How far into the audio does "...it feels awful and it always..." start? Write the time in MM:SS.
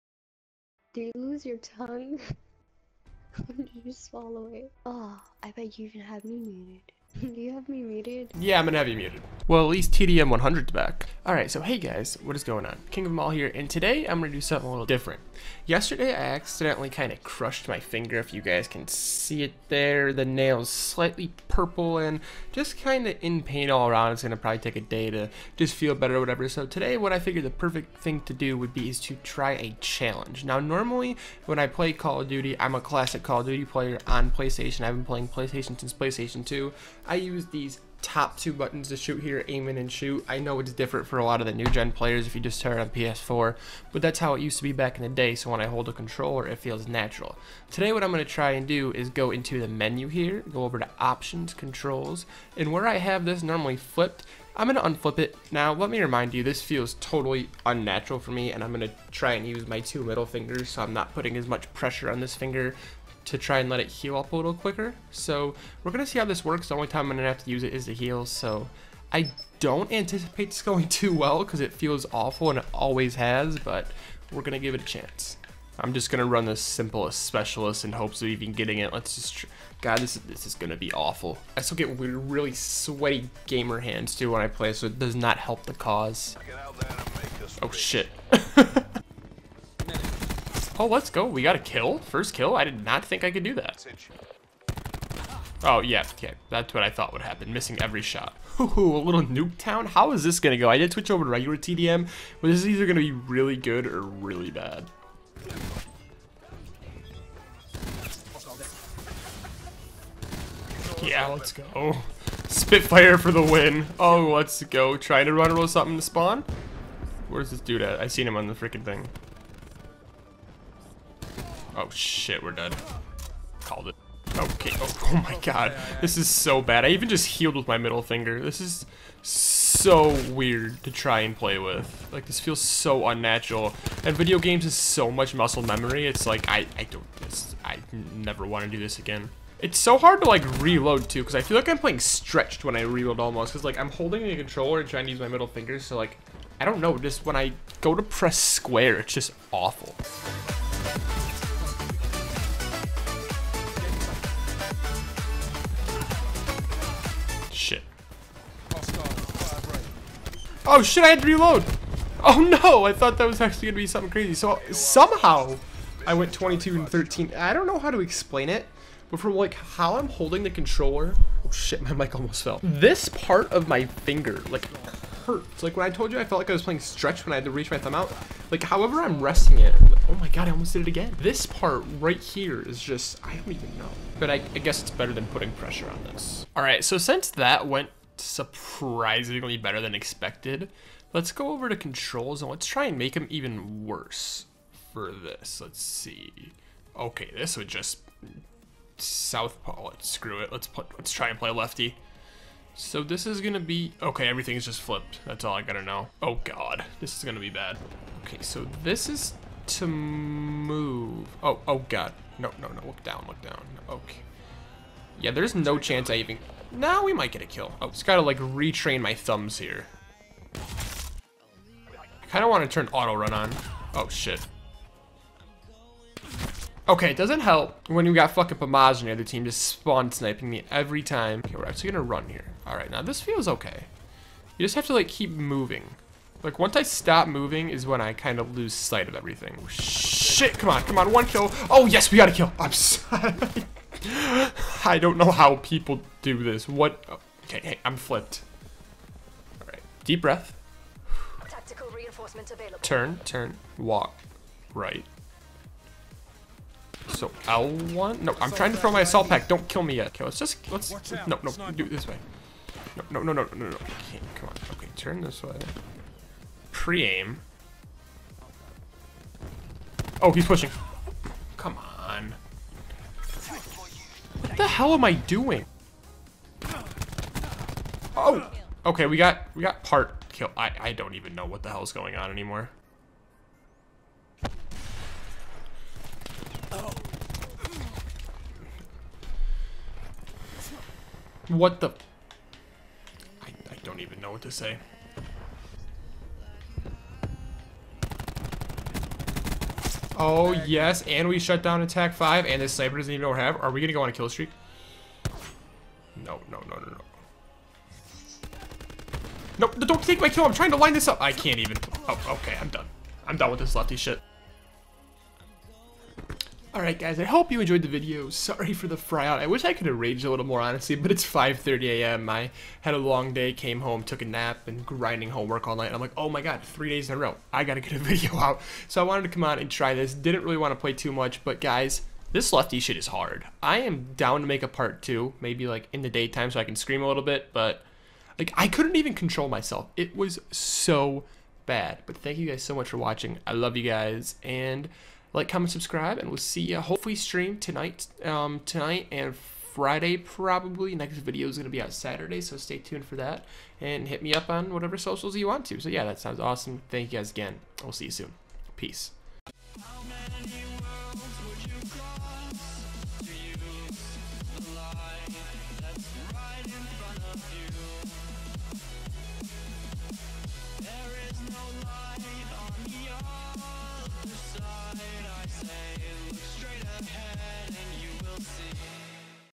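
01:11.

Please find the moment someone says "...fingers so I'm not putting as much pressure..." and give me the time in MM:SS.
01:00.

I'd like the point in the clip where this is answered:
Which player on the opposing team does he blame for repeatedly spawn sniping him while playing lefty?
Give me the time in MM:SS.
03:48.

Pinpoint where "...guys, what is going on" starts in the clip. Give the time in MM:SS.
00:11.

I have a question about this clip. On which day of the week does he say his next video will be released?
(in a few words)
Saturday.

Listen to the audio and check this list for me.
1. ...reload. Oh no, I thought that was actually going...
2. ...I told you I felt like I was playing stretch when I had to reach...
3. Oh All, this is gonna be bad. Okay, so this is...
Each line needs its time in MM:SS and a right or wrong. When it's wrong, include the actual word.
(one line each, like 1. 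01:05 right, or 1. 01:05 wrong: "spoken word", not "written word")
1. 02:41 right
2. 02:55 right
3. 03:26 wrong: "God", not "All".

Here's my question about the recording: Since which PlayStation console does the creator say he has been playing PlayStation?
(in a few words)
PlayStation 2.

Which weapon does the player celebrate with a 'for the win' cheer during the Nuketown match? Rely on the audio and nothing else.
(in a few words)
Spitfire.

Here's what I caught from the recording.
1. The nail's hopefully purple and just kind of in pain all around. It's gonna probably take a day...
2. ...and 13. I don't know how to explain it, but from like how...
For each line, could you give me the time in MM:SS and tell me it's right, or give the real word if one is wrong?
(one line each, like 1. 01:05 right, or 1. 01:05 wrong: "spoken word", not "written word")
1. 00:20 wrong: "slightly", not "hopefully"
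2. 02:46 right.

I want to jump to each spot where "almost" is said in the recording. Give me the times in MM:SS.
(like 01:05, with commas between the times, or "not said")
02:23, 02:52, 03:00.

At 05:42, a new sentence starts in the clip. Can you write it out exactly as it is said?
But thank you guys so much for watching.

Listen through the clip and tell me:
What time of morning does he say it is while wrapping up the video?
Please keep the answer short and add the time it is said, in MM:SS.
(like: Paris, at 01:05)
5:30 a.m., at 05:21.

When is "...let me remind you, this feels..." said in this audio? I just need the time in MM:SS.
00:55.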